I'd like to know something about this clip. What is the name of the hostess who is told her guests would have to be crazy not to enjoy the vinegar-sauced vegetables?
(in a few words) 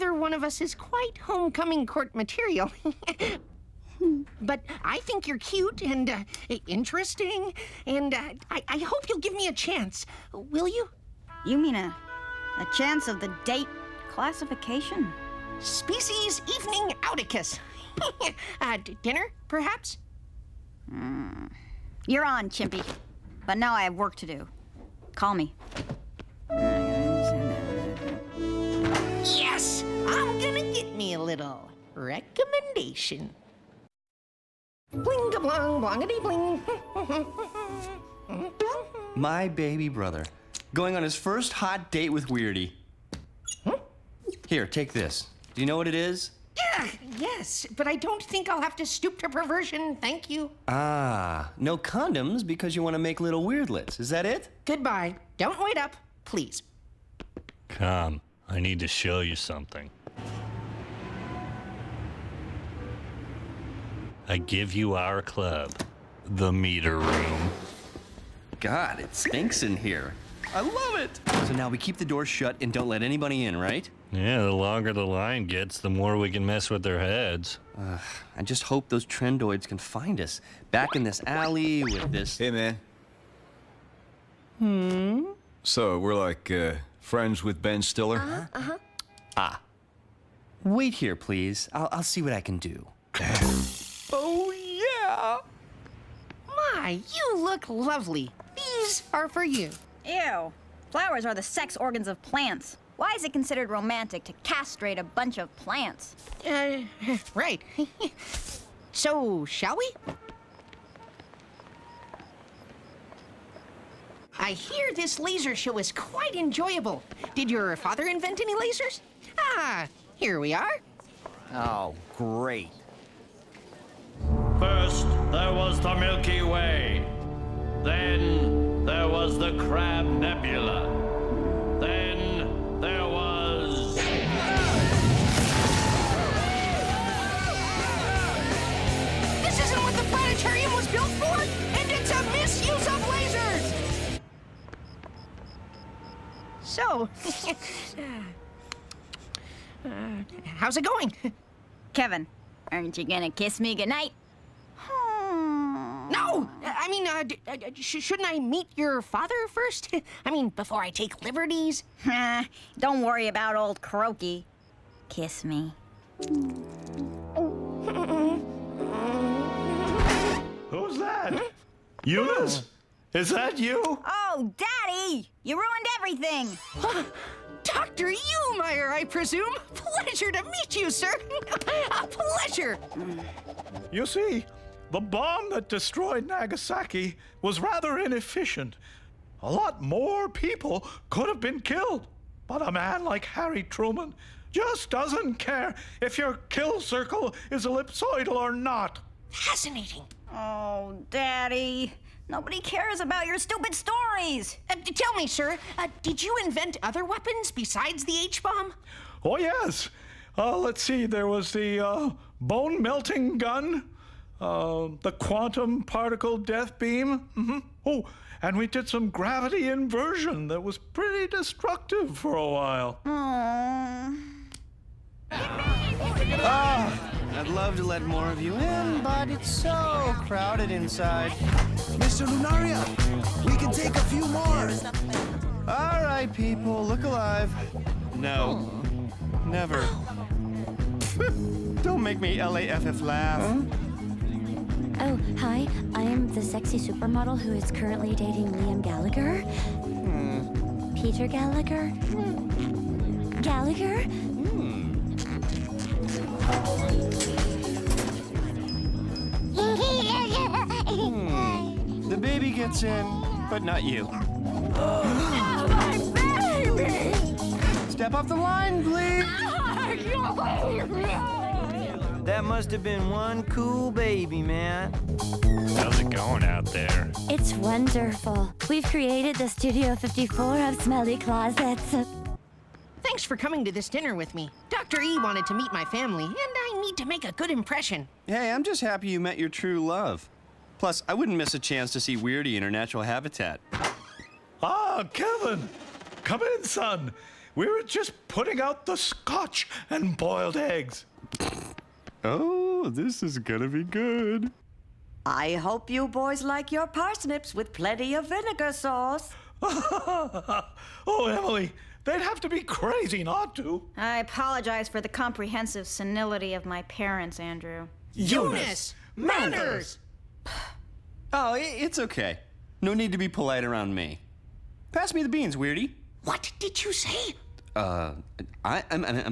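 Emily.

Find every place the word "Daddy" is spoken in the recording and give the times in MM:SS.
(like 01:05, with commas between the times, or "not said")
02:54, 03:21.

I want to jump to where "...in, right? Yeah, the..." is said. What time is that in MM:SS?
01:13.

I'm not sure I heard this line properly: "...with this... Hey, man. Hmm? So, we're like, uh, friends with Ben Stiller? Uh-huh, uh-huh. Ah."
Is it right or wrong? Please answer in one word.
right.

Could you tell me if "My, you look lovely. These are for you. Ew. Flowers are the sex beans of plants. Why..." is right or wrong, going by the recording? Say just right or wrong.
wrong.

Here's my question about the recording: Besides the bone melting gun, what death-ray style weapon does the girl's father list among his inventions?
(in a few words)
quantum particle death beam.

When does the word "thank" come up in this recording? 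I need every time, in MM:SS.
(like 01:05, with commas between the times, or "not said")
00:49, 04:43.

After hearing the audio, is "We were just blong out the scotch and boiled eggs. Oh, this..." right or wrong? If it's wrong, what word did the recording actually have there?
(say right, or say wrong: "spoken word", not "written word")
wrong: "putting", not "blong".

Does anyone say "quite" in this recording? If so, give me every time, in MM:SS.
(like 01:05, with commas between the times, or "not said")
00:00, 01:55.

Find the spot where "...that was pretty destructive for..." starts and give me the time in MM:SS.
03:40.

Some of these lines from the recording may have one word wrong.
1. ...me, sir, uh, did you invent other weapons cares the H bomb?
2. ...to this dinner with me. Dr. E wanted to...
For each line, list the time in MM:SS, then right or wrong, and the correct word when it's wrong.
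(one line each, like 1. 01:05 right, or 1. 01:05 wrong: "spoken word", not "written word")
1. 03:25 wrong: "besides", not "cares"
2. 04:43 right.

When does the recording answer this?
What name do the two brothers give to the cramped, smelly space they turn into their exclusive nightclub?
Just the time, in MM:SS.
01:06.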